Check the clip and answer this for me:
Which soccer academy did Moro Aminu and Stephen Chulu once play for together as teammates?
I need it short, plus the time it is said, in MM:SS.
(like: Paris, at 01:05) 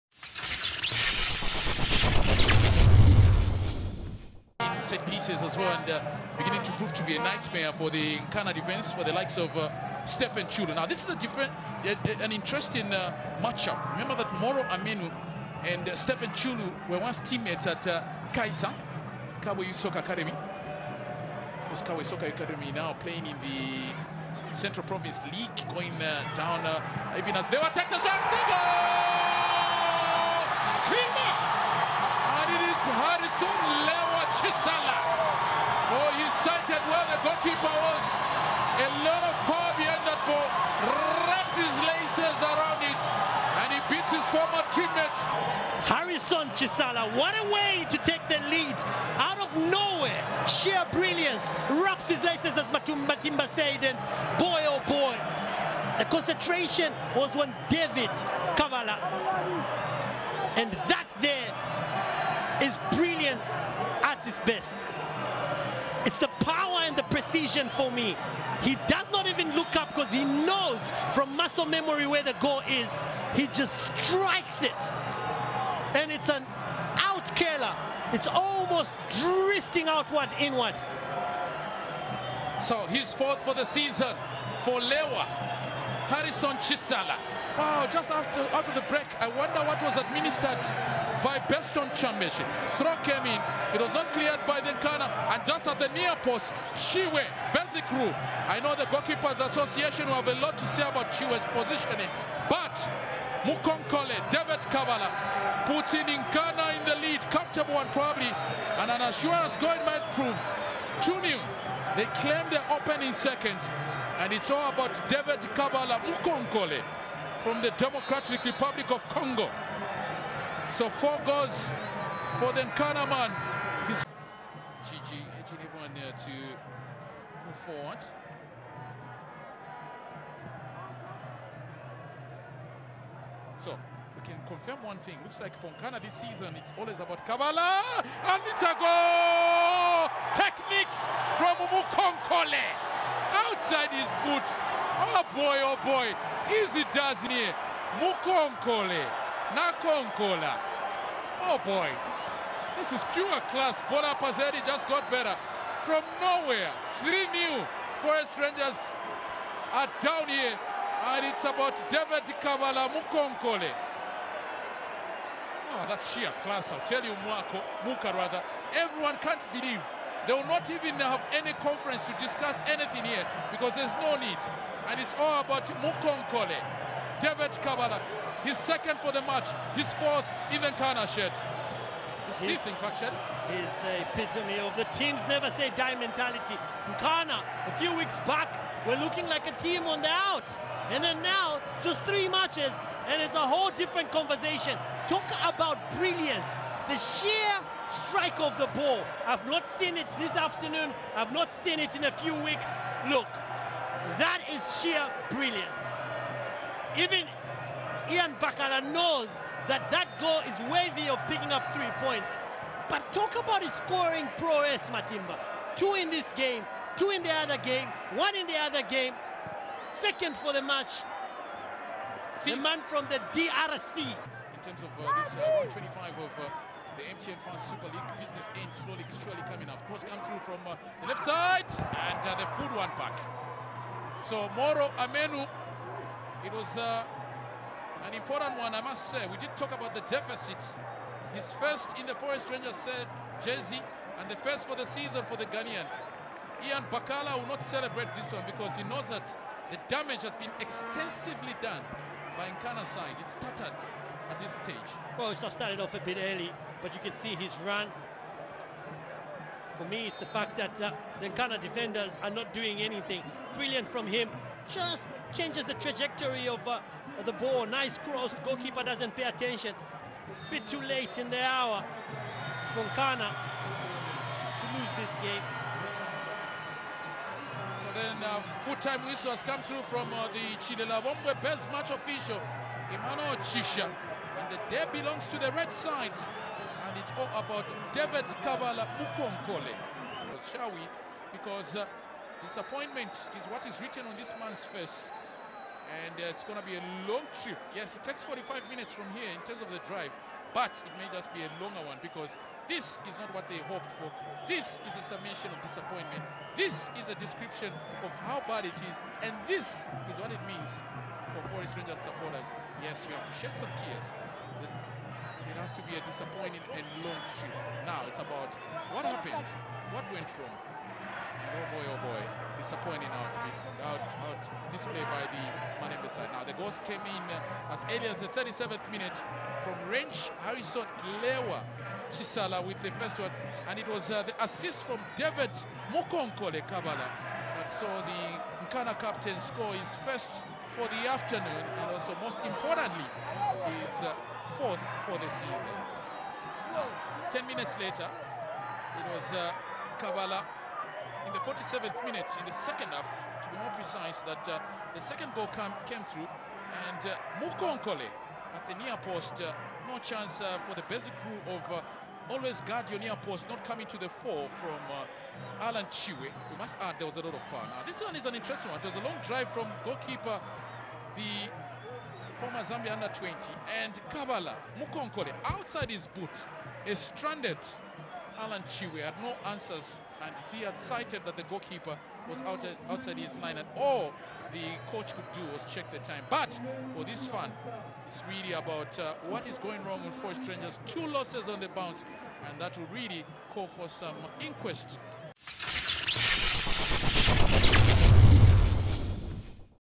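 Kawe Soccer Academy, at 00:19.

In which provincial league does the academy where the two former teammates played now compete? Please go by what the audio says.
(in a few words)
Central Province League.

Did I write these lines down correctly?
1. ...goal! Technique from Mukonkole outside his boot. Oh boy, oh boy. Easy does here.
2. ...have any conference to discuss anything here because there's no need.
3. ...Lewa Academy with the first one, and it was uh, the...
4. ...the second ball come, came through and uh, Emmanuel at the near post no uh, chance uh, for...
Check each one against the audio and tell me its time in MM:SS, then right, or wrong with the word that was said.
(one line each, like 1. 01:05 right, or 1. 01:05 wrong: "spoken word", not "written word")
1. 02:18 right
2. 02:50 right
3. 05:31 wrong: "Chisala", not "Academy"
4. 05:54 wrong: "Mukonkole", not "Emmanuel".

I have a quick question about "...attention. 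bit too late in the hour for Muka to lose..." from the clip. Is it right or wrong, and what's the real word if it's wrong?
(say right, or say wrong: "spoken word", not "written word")
wrong: "Nkana", not "Muka".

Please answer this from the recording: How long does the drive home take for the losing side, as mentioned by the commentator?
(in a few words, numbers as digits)
45 minutes.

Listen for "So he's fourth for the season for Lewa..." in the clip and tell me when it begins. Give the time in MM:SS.
01:22.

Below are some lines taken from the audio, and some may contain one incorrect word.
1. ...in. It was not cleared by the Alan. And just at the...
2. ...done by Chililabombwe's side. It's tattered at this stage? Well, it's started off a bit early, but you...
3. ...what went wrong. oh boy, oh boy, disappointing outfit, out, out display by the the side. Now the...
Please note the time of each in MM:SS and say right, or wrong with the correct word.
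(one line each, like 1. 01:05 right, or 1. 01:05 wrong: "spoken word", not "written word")
1. 01:33 wrong: "Nkana", not "Alan"
2. 04:11 wrong: "Nkana", not "Chililabombwe"
3. 05:19 right.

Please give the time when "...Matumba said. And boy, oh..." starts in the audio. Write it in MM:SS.
00:52.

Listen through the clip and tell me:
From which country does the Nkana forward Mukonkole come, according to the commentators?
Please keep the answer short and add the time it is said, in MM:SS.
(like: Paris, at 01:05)
Democratic Republic of Congo, at 01:57.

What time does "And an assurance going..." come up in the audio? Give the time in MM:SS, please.
01:48.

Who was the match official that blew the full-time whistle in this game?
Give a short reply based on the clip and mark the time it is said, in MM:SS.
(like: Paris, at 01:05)
Emmanuel Chisha, at 04:42.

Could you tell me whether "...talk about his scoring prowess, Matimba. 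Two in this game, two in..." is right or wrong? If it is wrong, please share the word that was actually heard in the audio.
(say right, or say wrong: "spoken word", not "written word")
right.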